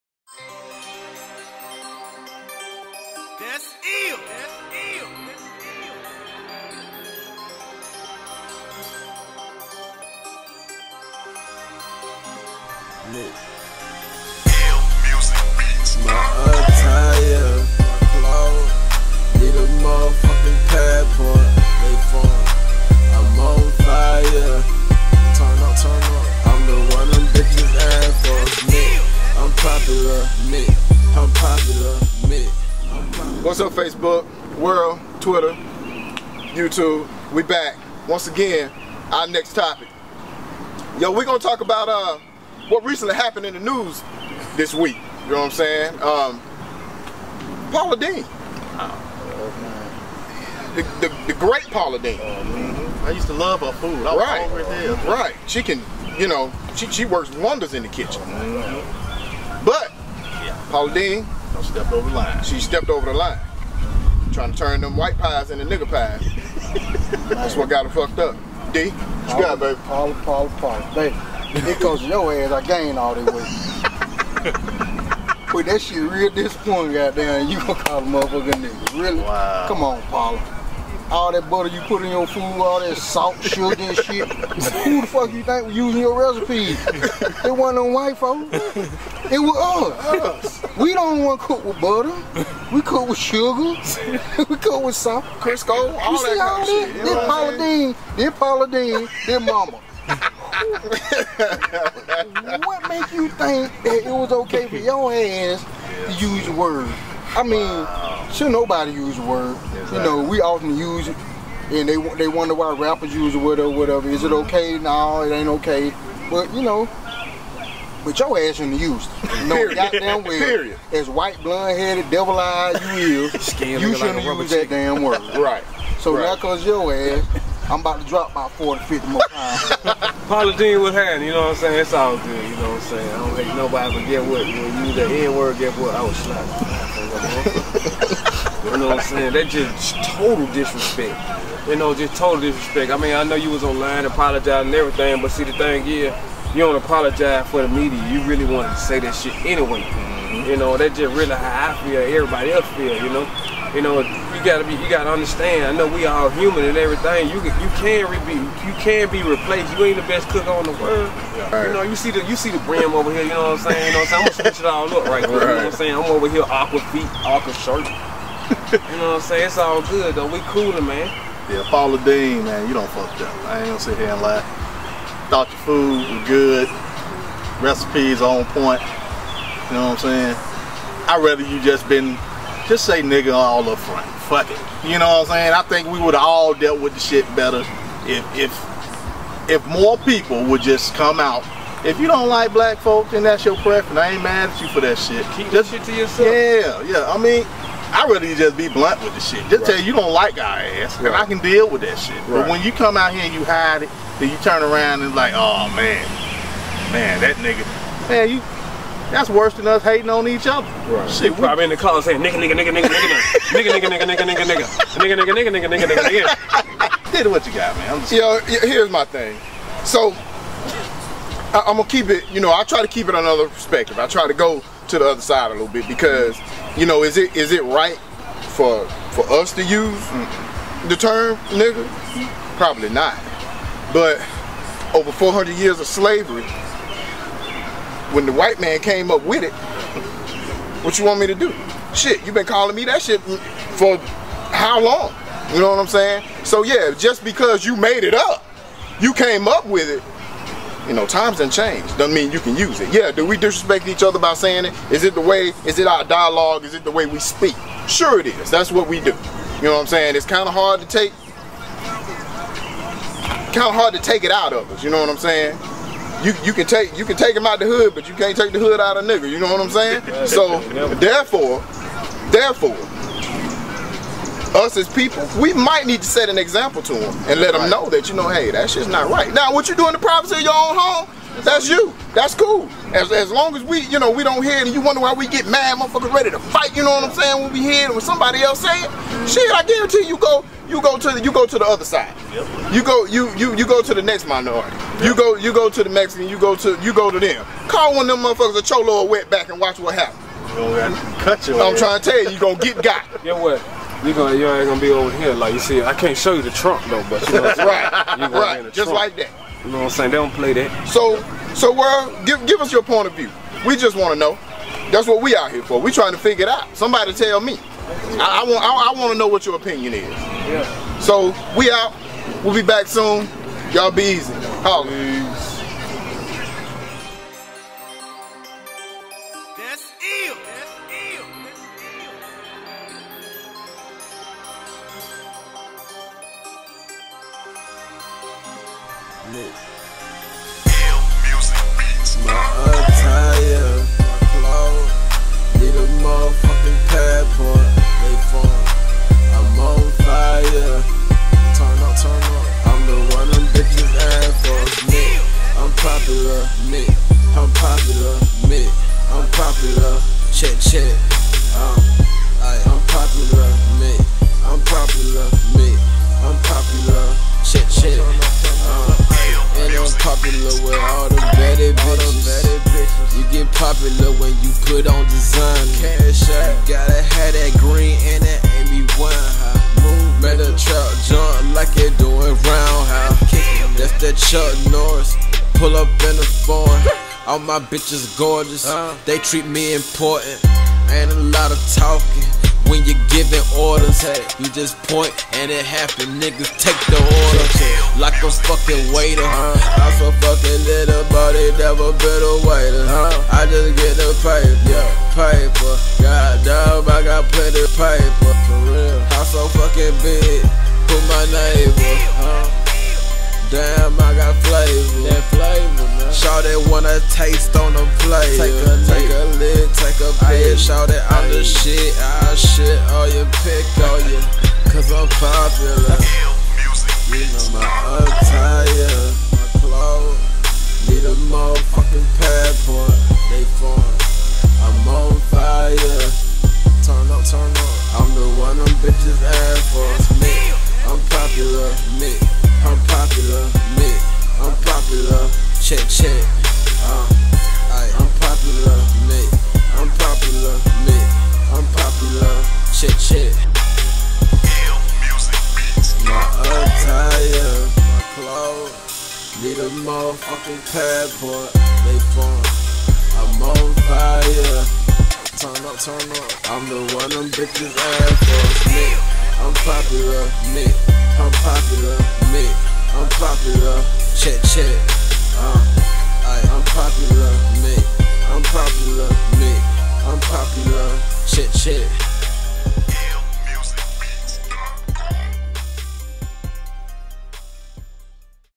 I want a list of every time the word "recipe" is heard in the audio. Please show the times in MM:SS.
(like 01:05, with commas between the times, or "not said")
01:26, 02:57.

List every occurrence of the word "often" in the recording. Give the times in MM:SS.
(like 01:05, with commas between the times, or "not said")
01:50.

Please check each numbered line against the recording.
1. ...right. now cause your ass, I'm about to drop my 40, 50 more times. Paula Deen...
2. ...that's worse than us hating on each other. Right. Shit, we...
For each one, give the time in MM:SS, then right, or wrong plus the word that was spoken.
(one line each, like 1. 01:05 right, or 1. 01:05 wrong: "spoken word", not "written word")
1. 02:06 right
2. 03:29 right.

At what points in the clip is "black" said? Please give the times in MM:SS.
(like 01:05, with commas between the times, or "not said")
03:12.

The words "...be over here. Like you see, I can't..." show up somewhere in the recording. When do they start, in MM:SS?
05:04.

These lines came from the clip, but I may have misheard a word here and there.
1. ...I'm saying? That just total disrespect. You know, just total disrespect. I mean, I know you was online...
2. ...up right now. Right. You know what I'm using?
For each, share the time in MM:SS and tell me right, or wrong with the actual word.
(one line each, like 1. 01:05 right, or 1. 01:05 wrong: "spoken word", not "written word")
1. 02:18 right
2. 02:44 wrong: "saying", not "using".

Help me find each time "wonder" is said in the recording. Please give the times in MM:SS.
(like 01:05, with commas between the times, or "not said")
00:57, 01:52, 04:44.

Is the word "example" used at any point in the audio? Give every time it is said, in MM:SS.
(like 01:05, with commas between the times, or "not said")
04:36.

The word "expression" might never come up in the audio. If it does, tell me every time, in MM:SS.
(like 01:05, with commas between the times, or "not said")
not said.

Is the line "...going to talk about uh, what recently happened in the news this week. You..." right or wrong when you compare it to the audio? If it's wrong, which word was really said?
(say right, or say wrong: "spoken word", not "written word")
right.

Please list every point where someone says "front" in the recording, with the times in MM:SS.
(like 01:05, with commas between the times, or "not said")
03:03.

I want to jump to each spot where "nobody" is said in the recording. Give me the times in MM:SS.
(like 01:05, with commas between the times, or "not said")
01:48, 02:13.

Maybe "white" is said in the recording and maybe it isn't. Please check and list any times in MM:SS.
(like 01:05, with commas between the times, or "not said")
01:04, 01:27, 02:01, 03:58.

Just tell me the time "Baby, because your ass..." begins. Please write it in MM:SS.
01:10.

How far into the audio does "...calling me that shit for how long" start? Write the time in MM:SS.
04:02.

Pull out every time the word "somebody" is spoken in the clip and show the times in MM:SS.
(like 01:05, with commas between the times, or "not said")
04:48, 05:16.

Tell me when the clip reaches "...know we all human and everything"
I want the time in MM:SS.
02:35.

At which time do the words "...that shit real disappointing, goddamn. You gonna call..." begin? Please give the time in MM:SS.
01:15.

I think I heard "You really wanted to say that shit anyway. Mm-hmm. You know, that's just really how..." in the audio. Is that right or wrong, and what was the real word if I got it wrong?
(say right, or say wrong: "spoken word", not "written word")
right.